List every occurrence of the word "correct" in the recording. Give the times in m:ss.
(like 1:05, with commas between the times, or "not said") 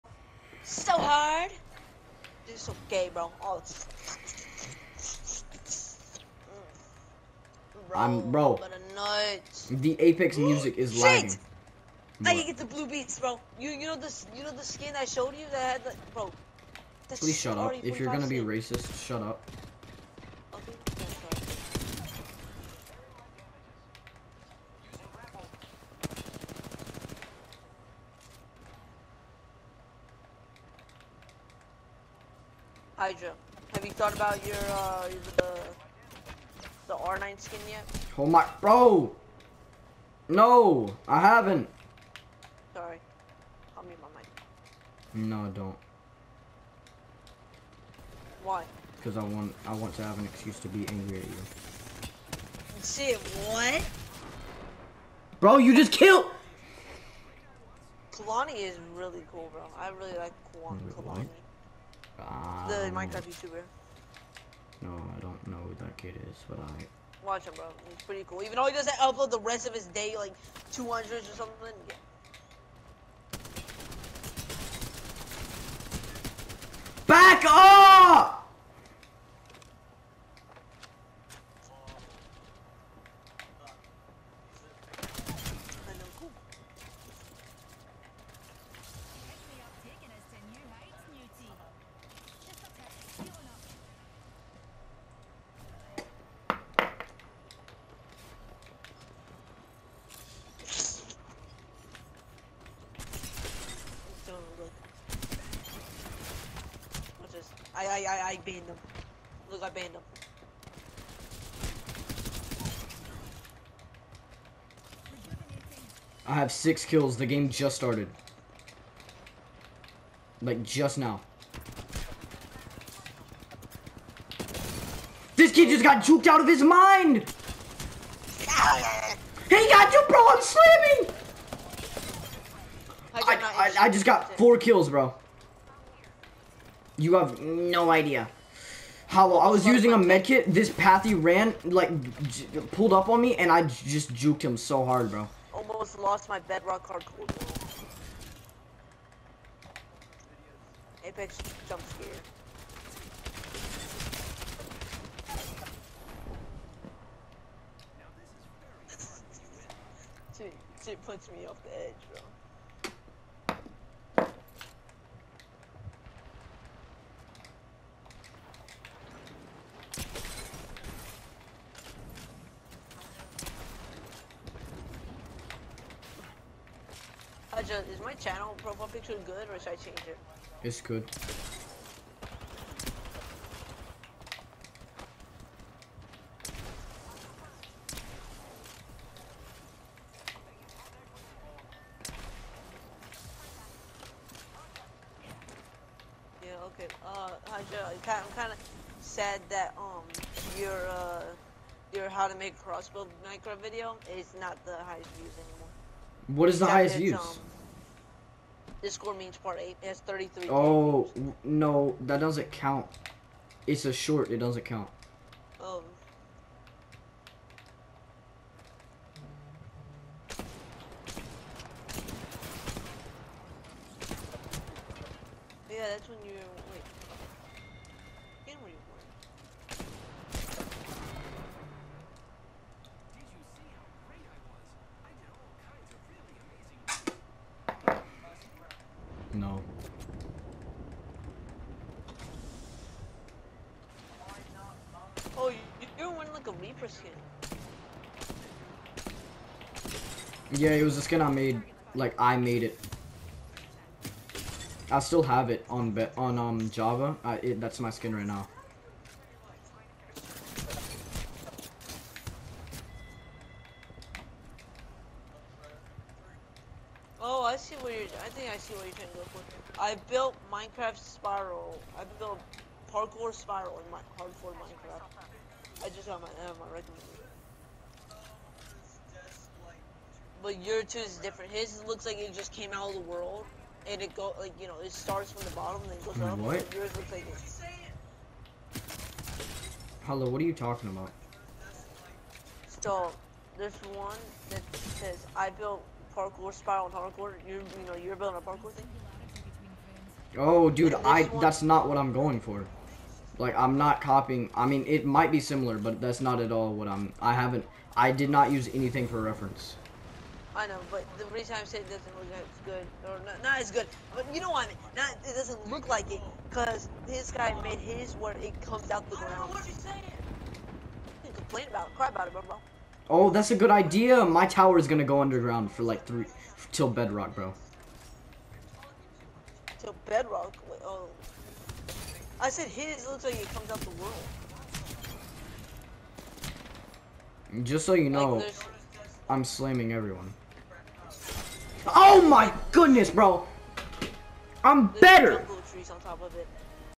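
not said.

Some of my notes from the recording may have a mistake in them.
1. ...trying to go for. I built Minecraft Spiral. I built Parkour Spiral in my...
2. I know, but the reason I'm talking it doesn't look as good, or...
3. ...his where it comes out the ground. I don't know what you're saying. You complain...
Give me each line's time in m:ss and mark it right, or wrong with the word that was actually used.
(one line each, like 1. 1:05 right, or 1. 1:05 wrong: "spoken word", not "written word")
1. 4:28 right
2. 5:10 wrong: "saying", not "talking"
3. 5:17 right.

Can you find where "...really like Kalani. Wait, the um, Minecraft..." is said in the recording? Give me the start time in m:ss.
0:59.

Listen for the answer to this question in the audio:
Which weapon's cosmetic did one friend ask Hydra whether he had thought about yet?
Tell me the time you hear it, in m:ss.
0:36.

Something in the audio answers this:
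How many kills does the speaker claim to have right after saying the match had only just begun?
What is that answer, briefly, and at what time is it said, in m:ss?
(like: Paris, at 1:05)
6, at 1:56.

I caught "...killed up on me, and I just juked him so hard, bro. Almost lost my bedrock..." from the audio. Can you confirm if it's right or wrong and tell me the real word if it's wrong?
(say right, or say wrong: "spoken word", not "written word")
wrong: "pulled", not "killed".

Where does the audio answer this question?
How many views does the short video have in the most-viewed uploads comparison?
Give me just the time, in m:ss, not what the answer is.
3:29.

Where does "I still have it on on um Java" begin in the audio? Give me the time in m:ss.
4:14.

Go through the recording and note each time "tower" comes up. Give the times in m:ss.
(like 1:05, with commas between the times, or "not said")
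5:24.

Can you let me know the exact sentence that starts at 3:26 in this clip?
What is the Except highest views?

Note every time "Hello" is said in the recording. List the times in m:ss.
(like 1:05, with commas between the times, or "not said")
4:50.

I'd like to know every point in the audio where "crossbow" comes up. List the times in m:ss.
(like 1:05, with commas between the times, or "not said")
3:22.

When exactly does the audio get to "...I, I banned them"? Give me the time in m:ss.
1:48.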